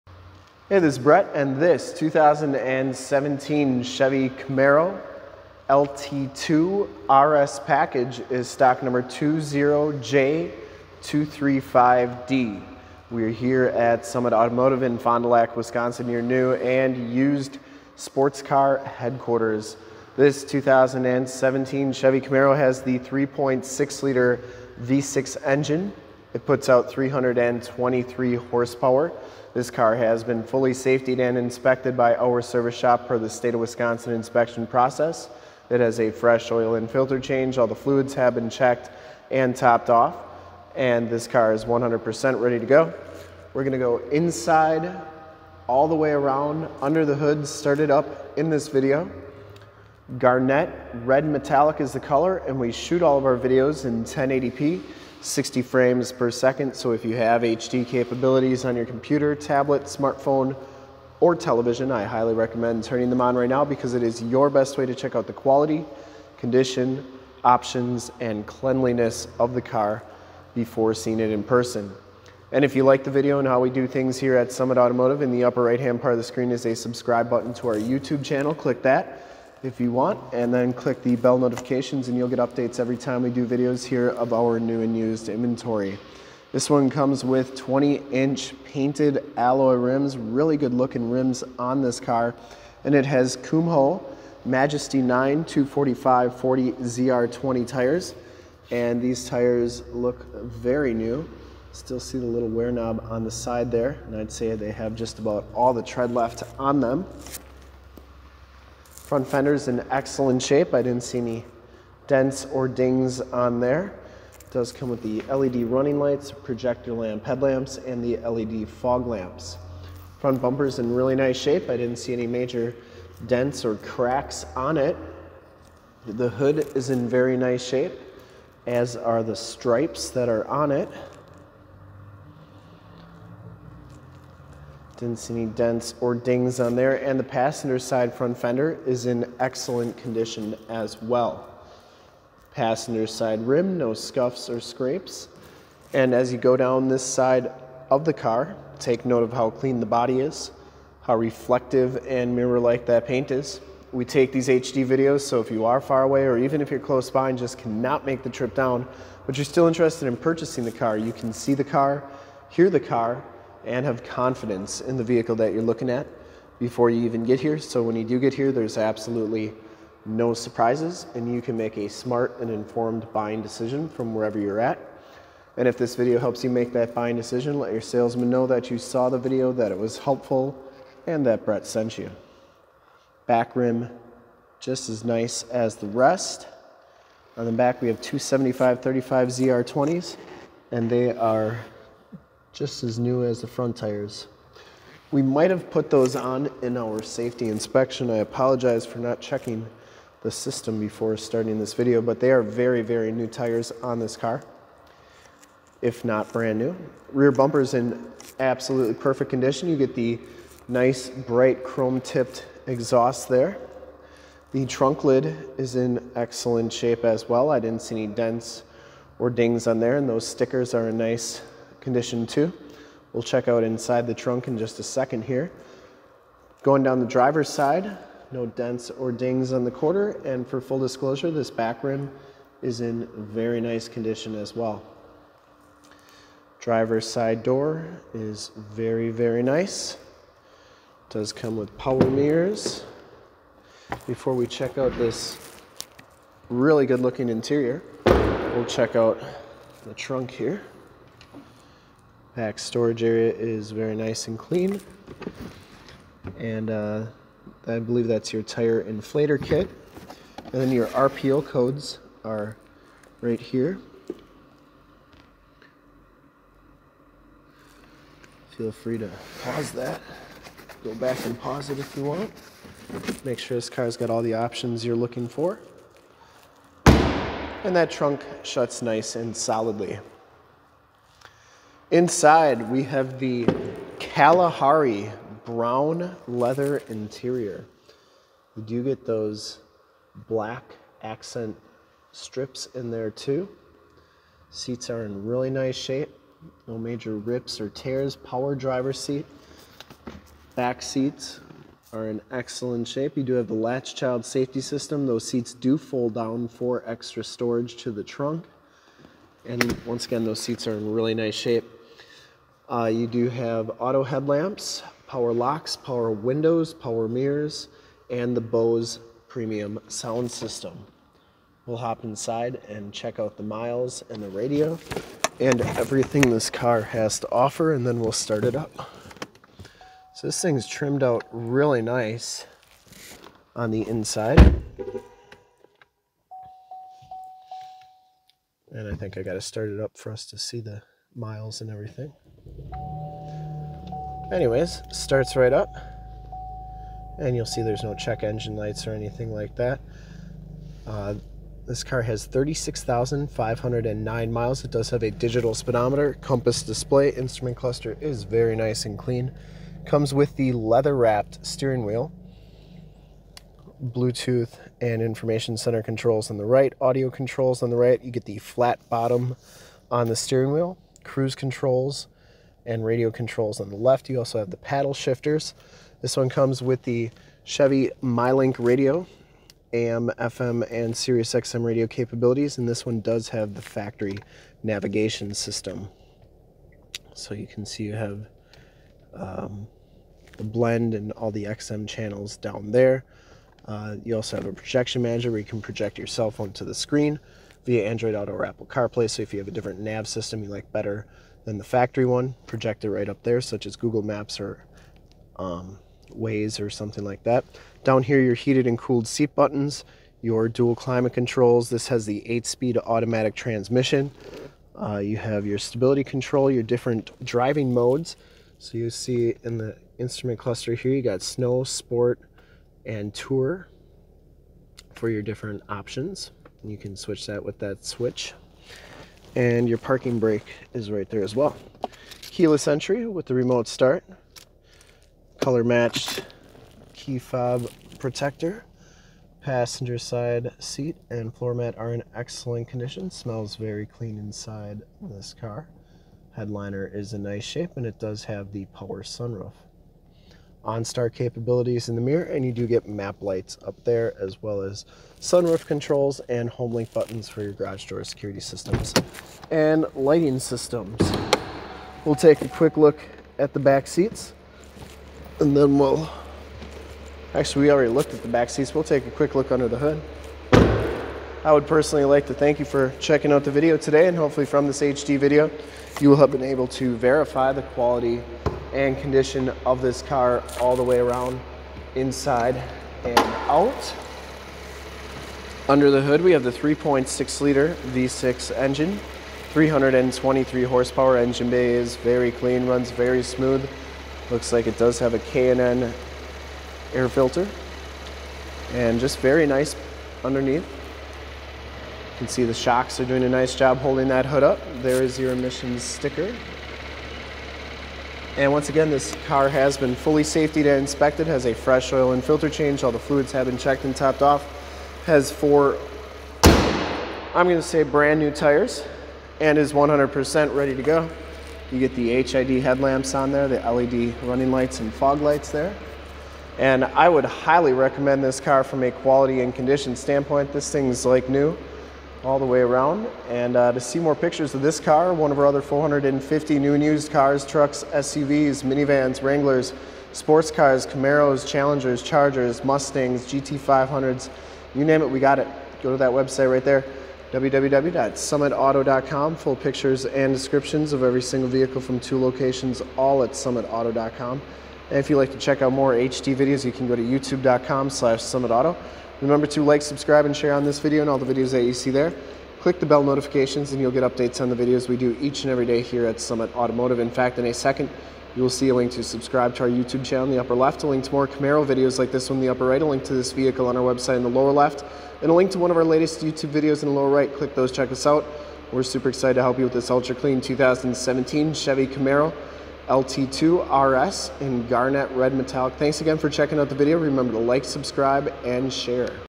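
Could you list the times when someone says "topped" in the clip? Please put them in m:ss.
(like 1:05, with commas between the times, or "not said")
0:39, 8:33.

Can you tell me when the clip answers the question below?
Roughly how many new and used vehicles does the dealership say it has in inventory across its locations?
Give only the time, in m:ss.
8:55.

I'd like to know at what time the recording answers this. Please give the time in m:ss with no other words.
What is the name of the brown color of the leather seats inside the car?
4:43.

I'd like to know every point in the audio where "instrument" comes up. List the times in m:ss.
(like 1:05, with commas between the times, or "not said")
5:57, 6:59.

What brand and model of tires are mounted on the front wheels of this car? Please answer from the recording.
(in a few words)
Kumho Majesty 9.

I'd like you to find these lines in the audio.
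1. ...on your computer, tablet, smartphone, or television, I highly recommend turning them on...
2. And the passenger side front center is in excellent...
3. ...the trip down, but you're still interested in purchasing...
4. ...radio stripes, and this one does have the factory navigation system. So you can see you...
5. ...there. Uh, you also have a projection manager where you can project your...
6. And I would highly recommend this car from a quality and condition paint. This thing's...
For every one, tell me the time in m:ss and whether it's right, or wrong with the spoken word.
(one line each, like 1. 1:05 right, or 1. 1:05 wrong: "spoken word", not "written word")
1. 0:58 right
2. 2:17 wrong: "fender", not "center"
3. 2:38 right
4. 6:21 wrong: "capabilities", not "stripes"
5. 6:32 right
6. 8:46 wrong: "standpoint", not "paint".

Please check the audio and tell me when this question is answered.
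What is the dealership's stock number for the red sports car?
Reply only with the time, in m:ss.
0:09.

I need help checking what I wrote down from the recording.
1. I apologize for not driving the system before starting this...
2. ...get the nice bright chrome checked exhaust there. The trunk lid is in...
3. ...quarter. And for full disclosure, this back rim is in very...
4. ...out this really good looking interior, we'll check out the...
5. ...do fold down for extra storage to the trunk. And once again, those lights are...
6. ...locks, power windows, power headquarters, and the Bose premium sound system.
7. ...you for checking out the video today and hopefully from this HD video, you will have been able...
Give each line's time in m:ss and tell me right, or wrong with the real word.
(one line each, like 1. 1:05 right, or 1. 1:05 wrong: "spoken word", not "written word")
1. 3:18 wrong: "checking", not "driving"
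2. 3:29 wrong: "tipped", not "checked"
3. 3:49 right
4. 4:04 right
5. 5:05 wrong: "seats", not "lights"
6. 5:15 wrong: "mirrors", not "headquarters"
7. 7:52 right.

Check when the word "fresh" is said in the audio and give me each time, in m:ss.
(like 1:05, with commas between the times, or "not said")
0:36, 8:31.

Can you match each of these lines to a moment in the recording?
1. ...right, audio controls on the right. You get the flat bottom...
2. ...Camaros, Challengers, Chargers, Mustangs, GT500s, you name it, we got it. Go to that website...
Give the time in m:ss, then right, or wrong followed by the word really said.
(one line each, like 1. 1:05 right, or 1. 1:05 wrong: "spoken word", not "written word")
1. 6:06 right
2. 9:00 right.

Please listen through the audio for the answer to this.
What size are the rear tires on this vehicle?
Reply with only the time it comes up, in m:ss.
3:08.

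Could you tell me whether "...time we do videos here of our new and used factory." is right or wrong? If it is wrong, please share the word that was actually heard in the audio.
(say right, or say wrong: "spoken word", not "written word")
wrong: "inventory", not "factory".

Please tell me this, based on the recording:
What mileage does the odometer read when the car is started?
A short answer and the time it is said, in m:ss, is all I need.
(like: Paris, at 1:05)
36,509, at 5:52.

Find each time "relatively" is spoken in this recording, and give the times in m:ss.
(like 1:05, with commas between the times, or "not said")
not said.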